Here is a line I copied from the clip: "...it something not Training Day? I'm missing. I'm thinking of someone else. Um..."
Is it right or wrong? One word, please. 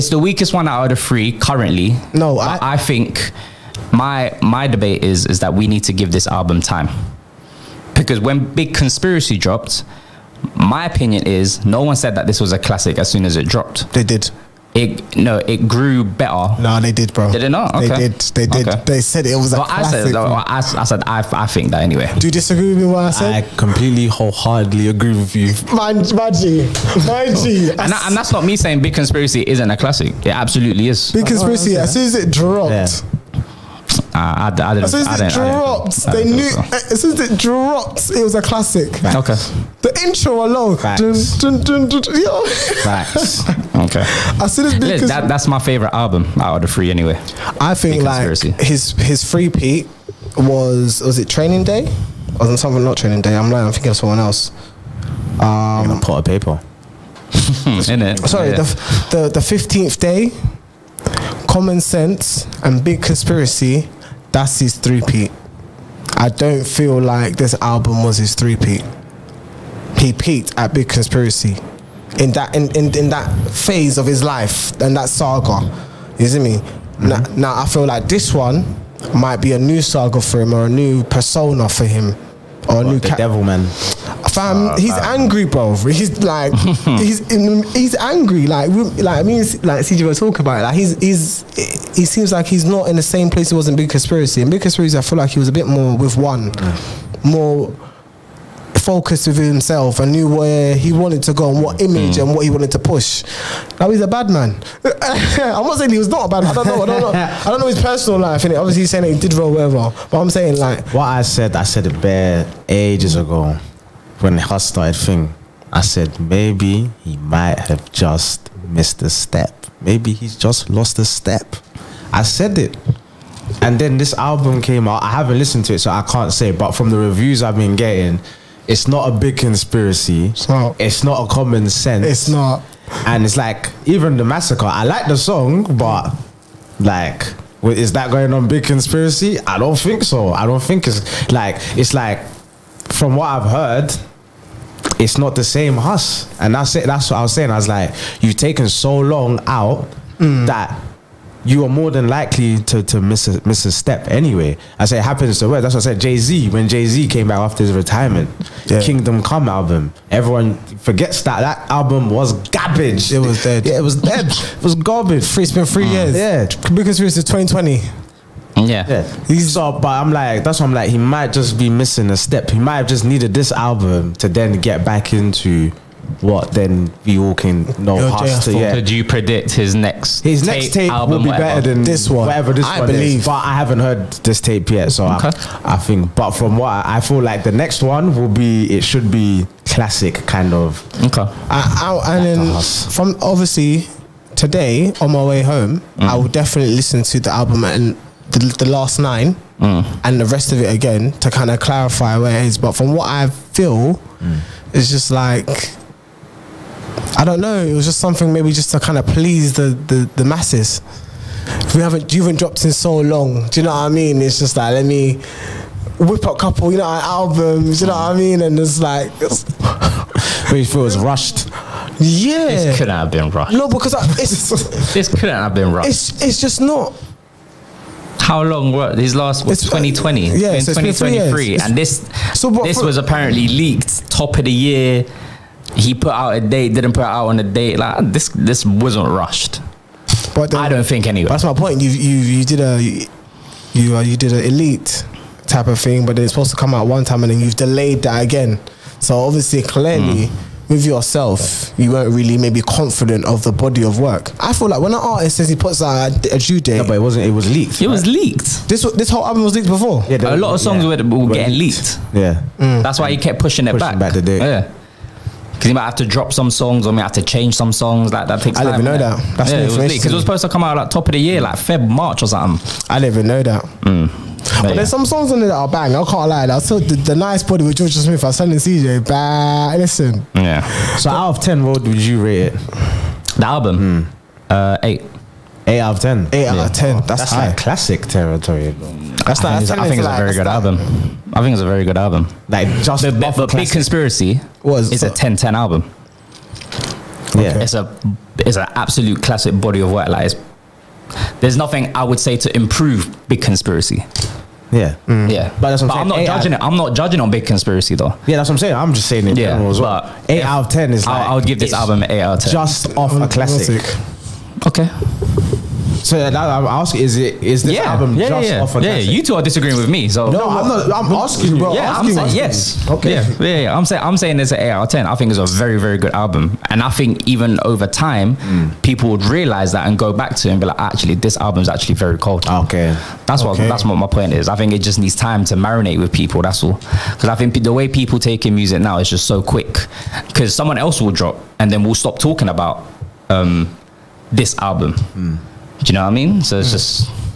wrong.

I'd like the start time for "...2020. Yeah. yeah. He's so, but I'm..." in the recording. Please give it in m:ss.
2:47.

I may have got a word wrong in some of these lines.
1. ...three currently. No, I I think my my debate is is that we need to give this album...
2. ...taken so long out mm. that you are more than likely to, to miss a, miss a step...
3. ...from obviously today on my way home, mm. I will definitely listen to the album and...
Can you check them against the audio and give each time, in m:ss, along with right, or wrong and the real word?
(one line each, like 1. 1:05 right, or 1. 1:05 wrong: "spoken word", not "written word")
1. 0:01 right
2. 2:28 right
3. 3:12 right.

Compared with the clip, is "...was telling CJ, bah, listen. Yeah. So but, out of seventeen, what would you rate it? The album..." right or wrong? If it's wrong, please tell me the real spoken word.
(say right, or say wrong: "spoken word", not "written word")
wrong: "ten", not "seventeen".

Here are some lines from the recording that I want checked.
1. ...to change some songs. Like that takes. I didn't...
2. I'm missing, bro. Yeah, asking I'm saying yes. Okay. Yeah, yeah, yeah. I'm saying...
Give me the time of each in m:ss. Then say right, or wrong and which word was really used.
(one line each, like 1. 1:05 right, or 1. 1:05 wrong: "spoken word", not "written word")
1. 4:27 right
2. 5:20 wrong: "asking", not "missing".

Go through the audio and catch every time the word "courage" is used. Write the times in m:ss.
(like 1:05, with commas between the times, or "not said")
not said.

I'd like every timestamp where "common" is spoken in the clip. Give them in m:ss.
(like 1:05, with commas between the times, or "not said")
1:01, 2:11.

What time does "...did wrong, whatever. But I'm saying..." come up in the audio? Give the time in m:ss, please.
1:49.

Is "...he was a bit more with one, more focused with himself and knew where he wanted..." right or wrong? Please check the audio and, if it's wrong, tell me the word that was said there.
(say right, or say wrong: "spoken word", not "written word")
right.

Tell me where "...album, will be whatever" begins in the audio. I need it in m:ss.
3:00.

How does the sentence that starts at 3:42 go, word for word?
Yeah, this couldn't have been rushed.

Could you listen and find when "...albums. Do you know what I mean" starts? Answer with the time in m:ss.
3:36.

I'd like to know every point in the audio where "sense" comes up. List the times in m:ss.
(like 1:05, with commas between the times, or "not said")
1:01, 2:11.